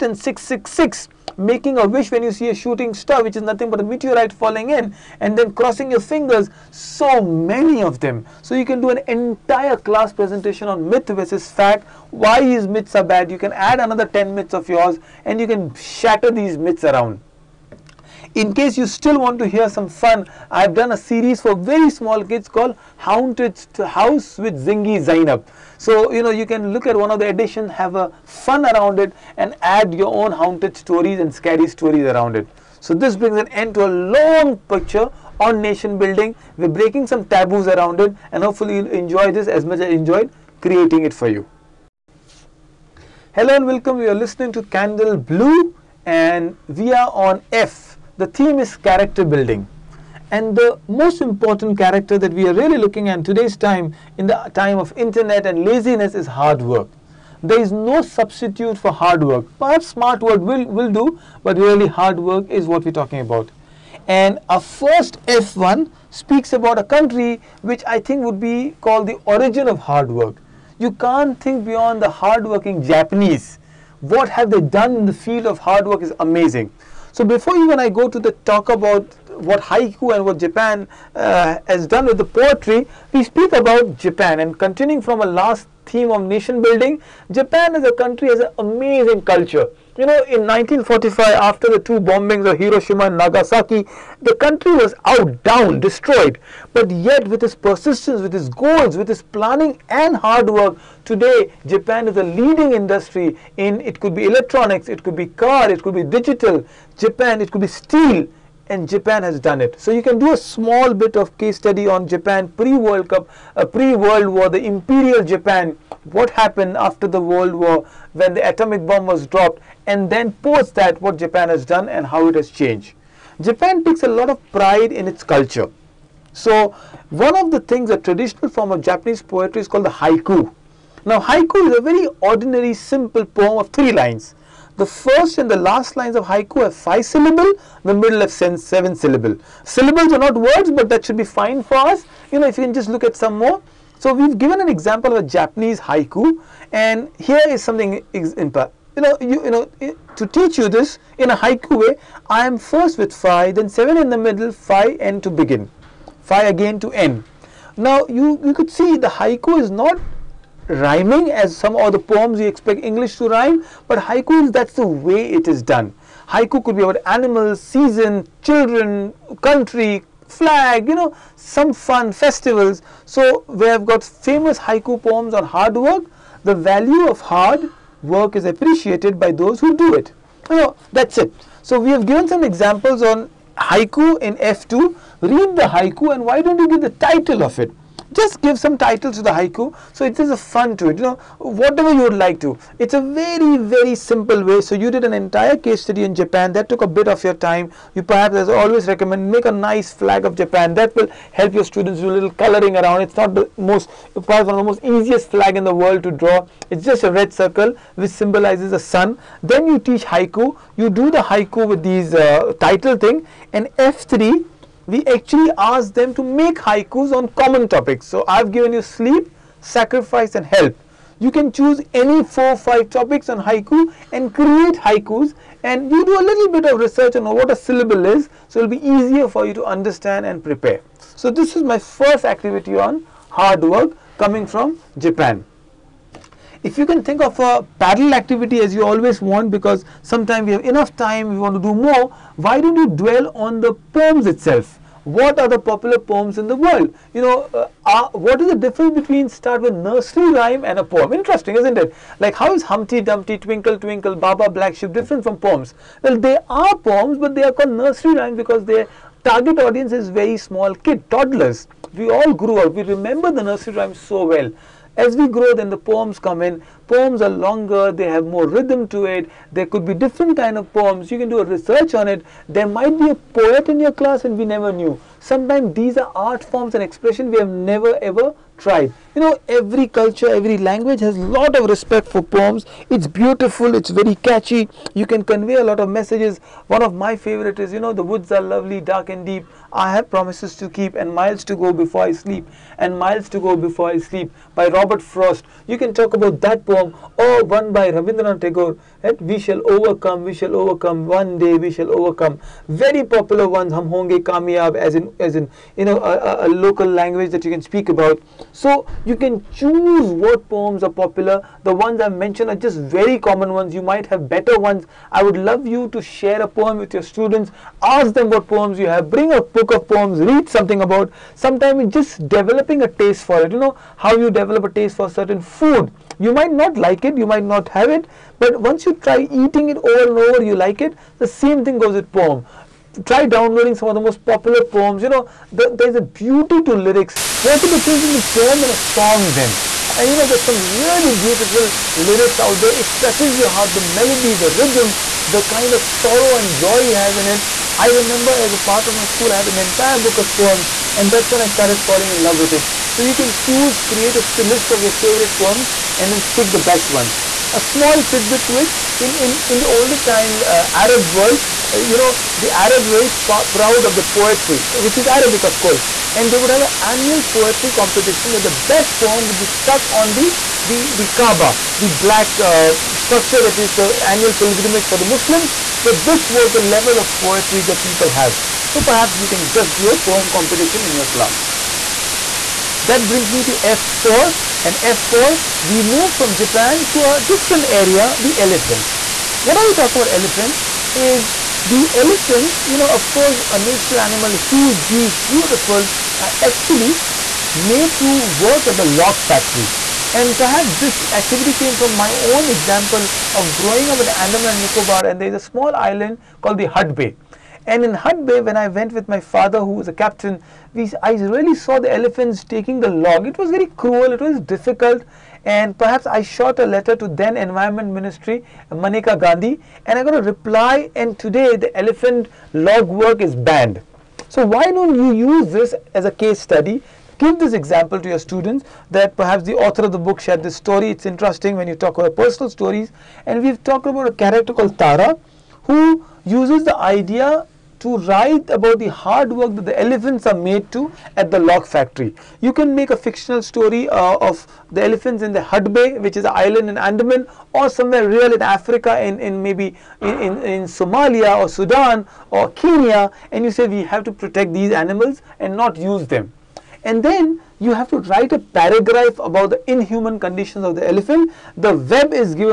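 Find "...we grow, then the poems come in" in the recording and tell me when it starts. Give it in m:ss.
4:25.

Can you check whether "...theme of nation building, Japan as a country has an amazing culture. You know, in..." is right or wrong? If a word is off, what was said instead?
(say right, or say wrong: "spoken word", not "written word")
right.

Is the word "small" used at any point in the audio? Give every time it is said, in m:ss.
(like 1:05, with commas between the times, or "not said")
0:21, 1:50, 4:20, 5:57, 6:45.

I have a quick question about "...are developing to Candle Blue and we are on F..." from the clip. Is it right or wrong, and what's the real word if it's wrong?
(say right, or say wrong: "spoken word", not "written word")
wrong: "listening", not "developing".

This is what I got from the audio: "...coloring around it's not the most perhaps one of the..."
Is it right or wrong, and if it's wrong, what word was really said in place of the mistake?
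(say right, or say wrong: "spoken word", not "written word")
right.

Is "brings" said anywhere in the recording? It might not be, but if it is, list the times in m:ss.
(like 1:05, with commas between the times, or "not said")
0:33, 5:19, 6:23.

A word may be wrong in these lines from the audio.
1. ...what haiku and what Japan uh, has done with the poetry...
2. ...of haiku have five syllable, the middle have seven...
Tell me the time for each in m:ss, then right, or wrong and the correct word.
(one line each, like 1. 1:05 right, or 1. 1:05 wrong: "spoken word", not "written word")
1. 1:19 right
2. 2:16 right.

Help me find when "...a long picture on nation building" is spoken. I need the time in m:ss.
0:33.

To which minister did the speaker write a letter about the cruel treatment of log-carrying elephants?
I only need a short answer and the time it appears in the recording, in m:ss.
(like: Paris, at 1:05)
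Maneka Gandhi, at 6:58.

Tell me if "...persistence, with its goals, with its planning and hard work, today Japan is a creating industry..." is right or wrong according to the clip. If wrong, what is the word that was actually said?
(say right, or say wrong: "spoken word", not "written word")
wrong: "leading", not "creating".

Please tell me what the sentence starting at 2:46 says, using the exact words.
Haiku could be about animals, season, children, country, flag, you know, some fun, festivals.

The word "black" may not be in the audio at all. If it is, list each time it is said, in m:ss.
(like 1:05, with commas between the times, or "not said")
4:14, 6:11.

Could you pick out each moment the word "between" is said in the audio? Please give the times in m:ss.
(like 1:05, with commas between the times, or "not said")
4:08, 5:38.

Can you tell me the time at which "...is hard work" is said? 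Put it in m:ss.
0:56.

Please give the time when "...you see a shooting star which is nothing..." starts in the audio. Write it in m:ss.
0:02.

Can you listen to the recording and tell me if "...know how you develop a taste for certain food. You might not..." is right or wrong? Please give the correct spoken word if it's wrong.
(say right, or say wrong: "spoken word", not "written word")
right.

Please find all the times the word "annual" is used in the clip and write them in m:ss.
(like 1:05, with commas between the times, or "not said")
6:06, 6:14.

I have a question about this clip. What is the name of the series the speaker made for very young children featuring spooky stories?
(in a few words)
Haunted House with Zingy Zainab.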